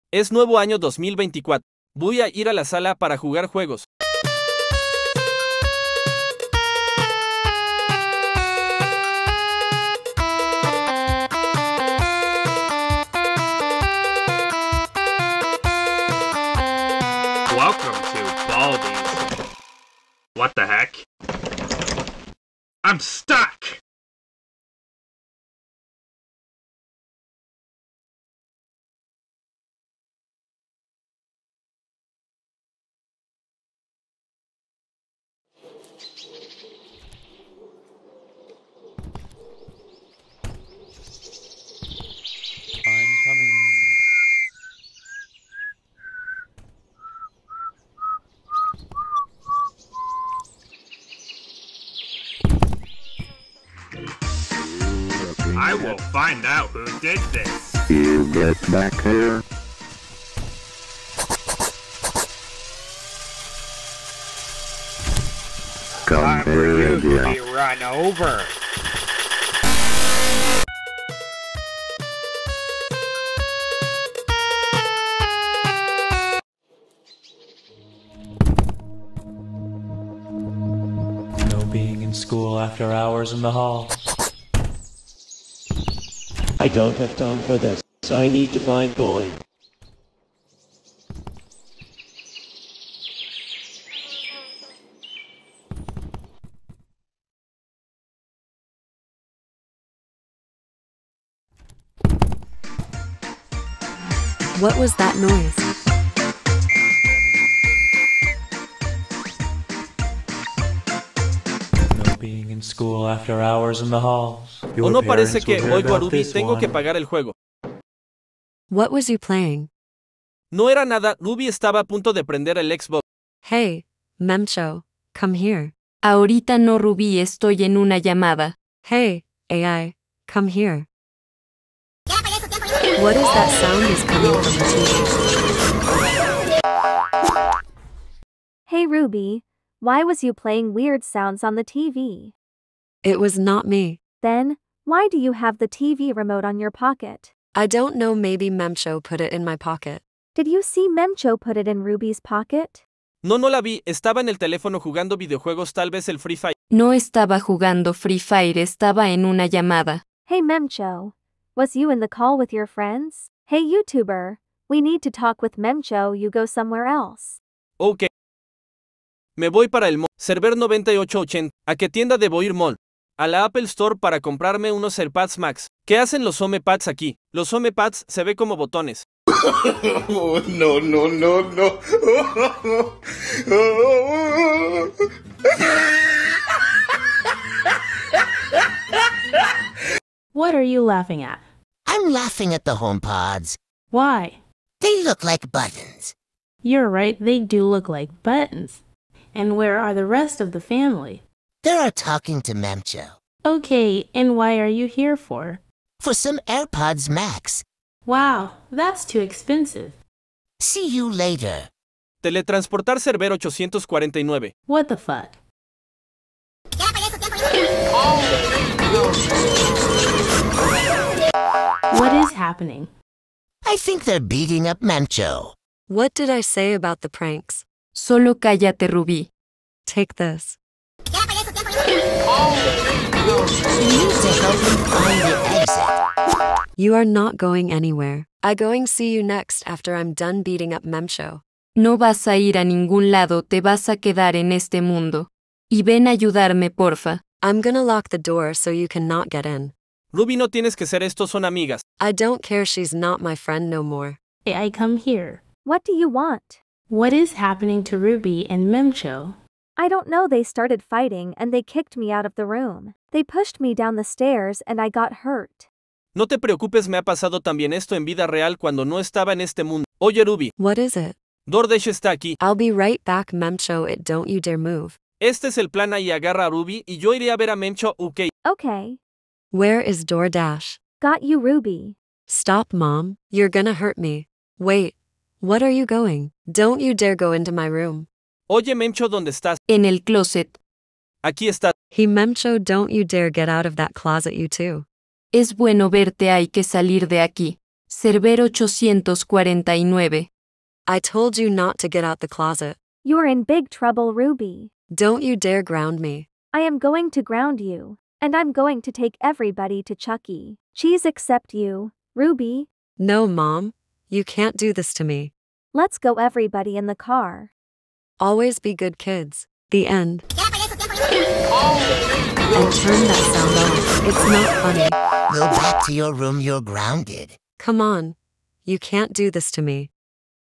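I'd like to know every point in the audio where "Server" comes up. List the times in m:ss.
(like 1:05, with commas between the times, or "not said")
2:50, 4:57.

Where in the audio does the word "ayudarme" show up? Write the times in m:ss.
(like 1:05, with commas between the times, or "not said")
4:06.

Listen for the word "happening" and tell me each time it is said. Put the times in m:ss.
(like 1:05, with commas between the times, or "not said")
3:42, 4:17.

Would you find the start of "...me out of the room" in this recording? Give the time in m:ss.
4:21.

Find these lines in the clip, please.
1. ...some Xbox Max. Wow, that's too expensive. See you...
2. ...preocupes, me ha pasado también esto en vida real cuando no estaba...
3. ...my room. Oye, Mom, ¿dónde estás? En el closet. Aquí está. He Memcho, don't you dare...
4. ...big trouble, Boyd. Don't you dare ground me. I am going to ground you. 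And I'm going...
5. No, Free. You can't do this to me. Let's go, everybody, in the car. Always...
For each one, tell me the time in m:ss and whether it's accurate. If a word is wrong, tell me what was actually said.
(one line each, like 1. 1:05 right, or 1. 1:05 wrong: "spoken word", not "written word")
1. 3:26 wrong: "AirPods", not "Xbox"
2. 4:26 right
3. 4:47 wrong: "Memcho", not "Mom"
4. 5:03 wrong: "Ruby", not "Boyd"
5. 5:12 wrong: "Mom", not "Free".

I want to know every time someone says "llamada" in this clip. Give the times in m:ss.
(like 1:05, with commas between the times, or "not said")
2:07, 2:39.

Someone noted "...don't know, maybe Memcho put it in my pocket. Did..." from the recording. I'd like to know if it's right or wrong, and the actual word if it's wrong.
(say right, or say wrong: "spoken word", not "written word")
right.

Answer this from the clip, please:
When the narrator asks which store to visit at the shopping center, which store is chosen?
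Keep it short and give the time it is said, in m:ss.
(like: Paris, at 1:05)
Apple Store, at 2:53.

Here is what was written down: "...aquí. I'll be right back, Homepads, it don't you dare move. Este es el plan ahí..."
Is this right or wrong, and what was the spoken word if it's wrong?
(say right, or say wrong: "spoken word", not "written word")
wrong: "Memcho", not "Homepads".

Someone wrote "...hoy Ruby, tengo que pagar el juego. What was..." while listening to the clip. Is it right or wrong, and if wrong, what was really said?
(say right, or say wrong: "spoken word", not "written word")
right.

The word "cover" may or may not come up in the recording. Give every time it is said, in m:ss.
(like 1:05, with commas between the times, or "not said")
not said.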